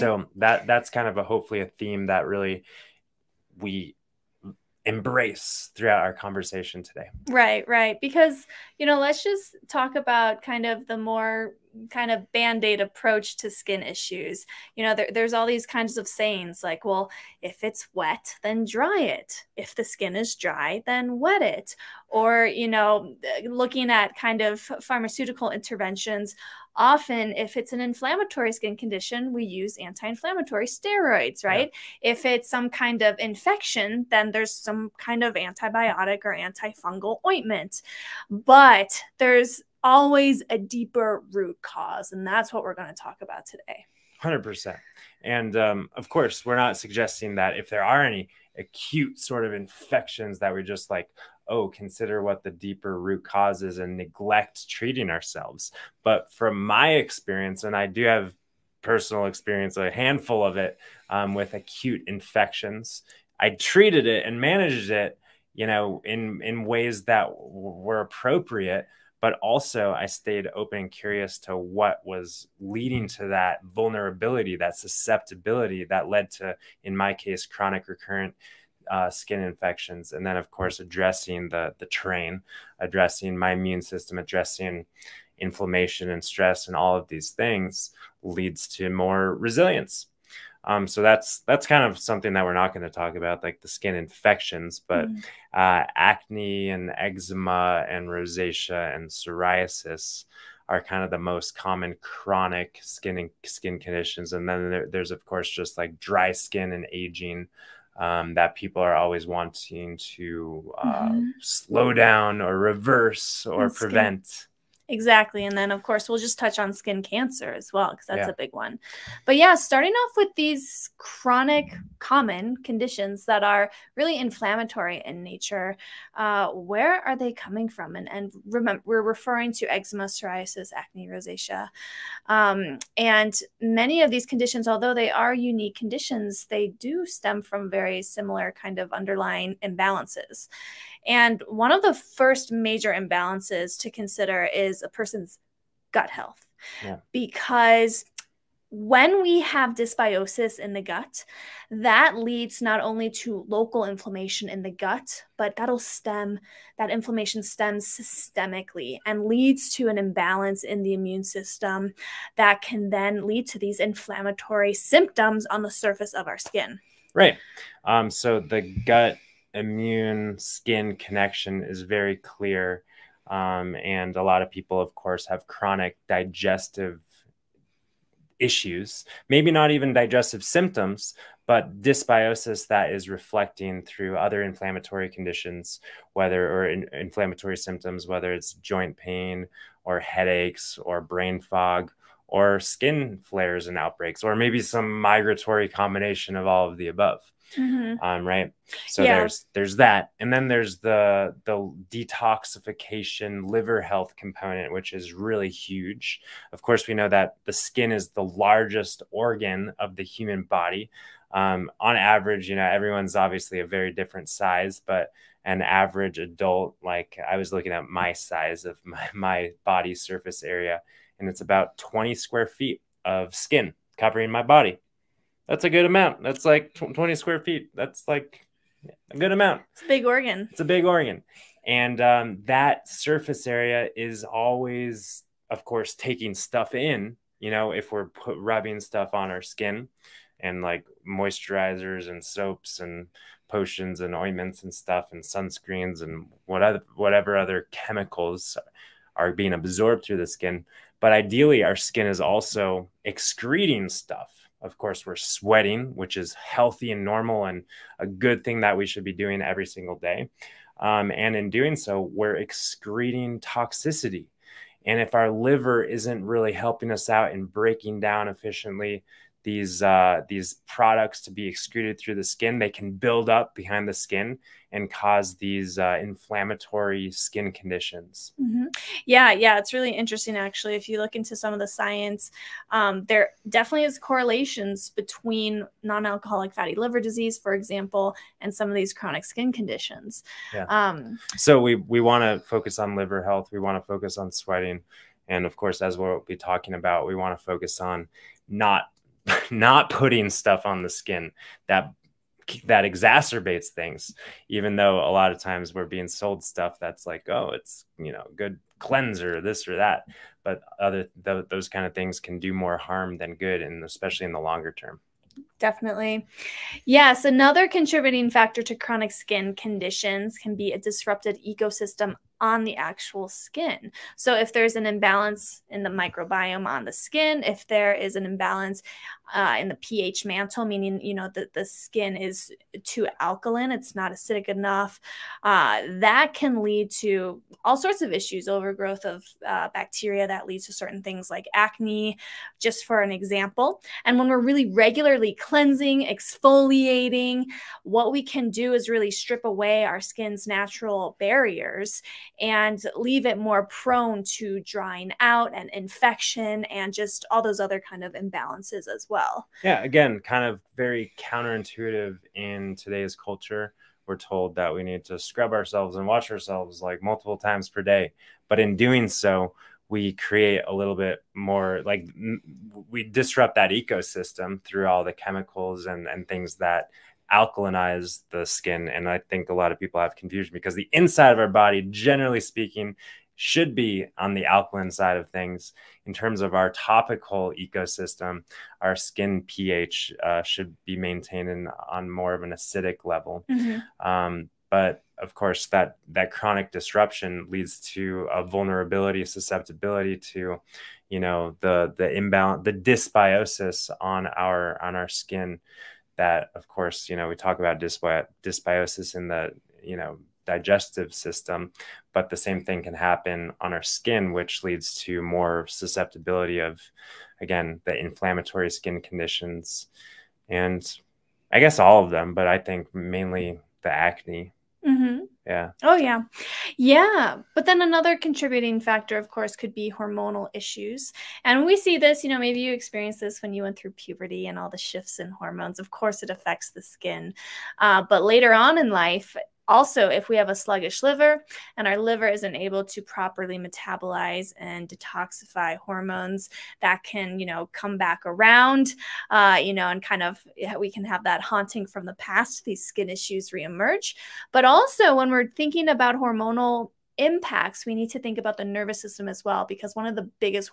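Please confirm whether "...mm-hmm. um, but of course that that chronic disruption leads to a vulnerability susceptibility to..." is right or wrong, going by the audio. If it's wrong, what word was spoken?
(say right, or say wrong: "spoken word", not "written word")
right.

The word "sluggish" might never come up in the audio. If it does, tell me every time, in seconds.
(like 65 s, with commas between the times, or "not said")
440 s.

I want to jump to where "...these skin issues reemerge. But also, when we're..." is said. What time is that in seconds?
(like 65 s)
452 s.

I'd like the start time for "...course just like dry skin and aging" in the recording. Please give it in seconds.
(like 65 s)
105 s.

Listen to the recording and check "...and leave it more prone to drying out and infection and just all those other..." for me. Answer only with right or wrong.
right.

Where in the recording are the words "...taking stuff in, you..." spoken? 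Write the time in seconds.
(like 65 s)
235 s.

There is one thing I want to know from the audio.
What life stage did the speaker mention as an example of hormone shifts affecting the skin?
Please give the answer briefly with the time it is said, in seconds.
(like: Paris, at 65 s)
puberty, at 433 s.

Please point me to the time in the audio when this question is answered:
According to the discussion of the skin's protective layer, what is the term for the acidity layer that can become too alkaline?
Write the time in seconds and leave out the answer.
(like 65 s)
329 s.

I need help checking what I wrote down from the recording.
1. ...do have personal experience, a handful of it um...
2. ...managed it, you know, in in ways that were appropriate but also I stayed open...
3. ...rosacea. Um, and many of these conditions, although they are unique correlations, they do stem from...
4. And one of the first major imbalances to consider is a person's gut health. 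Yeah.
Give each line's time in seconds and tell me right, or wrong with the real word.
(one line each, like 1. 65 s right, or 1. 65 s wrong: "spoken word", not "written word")
1. 57 s right
2. 64 s right
3. 131 s wrong: "conditions", not "correlations"
4. 141 s right.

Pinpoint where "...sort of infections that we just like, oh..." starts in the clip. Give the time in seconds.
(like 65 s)
49 s.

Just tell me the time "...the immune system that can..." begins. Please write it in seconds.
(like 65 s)
160 s.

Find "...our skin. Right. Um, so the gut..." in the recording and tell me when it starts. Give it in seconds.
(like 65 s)
166 s.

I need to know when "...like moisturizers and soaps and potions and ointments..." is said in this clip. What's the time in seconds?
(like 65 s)
240 s.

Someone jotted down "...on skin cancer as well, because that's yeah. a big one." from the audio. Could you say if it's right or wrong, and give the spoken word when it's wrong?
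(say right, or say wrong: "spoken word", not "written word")
right.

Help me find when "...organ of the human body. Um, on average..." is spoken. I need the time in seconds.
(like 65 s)
209 s.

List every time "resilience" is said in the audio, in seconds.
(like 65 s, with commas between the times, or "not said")
89 s.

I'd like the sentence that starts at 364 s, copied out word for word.
We're told that we need to scrub ourselves and wash ourselves like multiple times per day.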